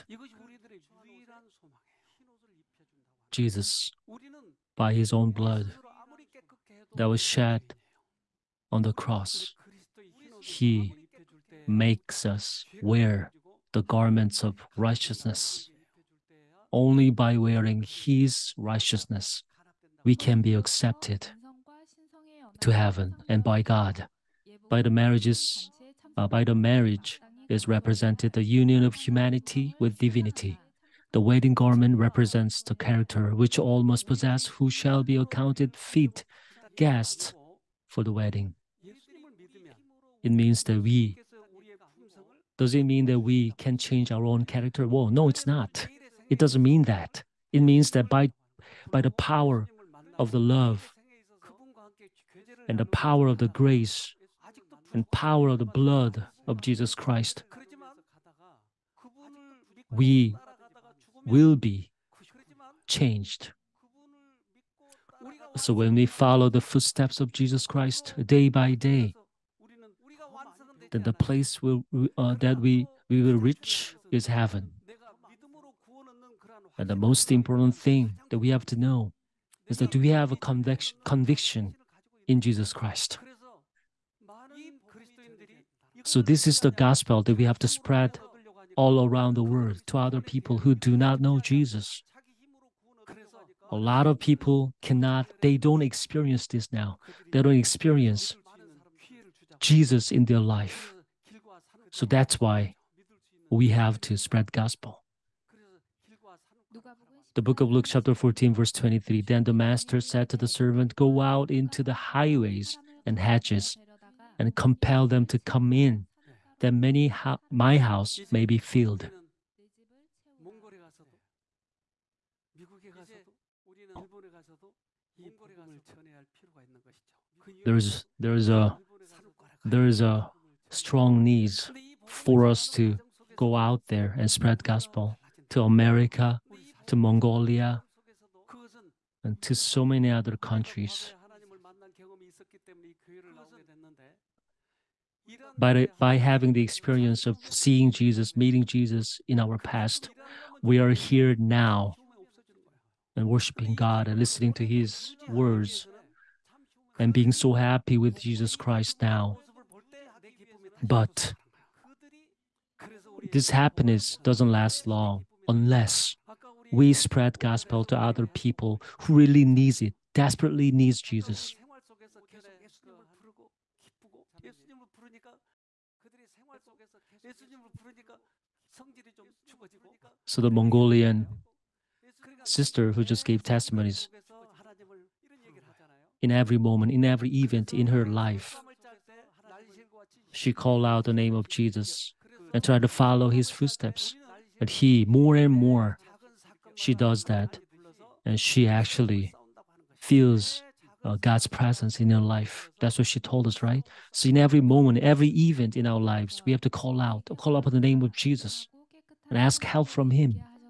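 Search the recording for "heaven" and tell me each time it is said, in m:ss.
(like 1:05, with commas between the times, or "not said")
0:22, 1:14.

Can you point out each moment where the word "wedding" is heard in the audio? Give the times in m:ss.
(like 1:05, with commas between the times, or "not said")
0:31, 0:38.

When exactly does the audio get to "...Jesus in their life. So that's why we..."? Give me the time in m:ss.
1:39.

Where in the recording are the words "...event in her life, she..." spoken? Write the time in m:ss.
3:07.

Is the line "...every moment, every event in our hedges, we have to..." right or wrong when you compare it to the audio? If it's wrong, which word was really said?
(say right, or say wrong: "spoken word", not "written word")
wrong: "lives", not "hedges".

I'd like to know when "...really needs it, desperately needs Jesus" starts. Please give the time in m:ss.
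2:49.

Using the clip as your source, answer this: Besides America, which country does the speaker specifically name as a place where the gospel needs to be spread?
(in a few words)
Mongolia.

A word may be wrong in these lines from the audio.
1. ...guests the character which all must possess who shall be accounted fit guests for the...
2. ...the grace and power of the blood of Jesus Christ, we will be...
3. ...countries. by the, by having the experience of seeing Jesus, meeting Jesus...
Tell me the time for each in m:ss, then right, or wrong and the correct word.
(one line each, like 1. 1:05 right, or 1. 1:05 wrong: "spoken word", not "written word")
1. 0:31 wrong: "represents", not "guests"
2. 0:53 right
3. 2:20 right.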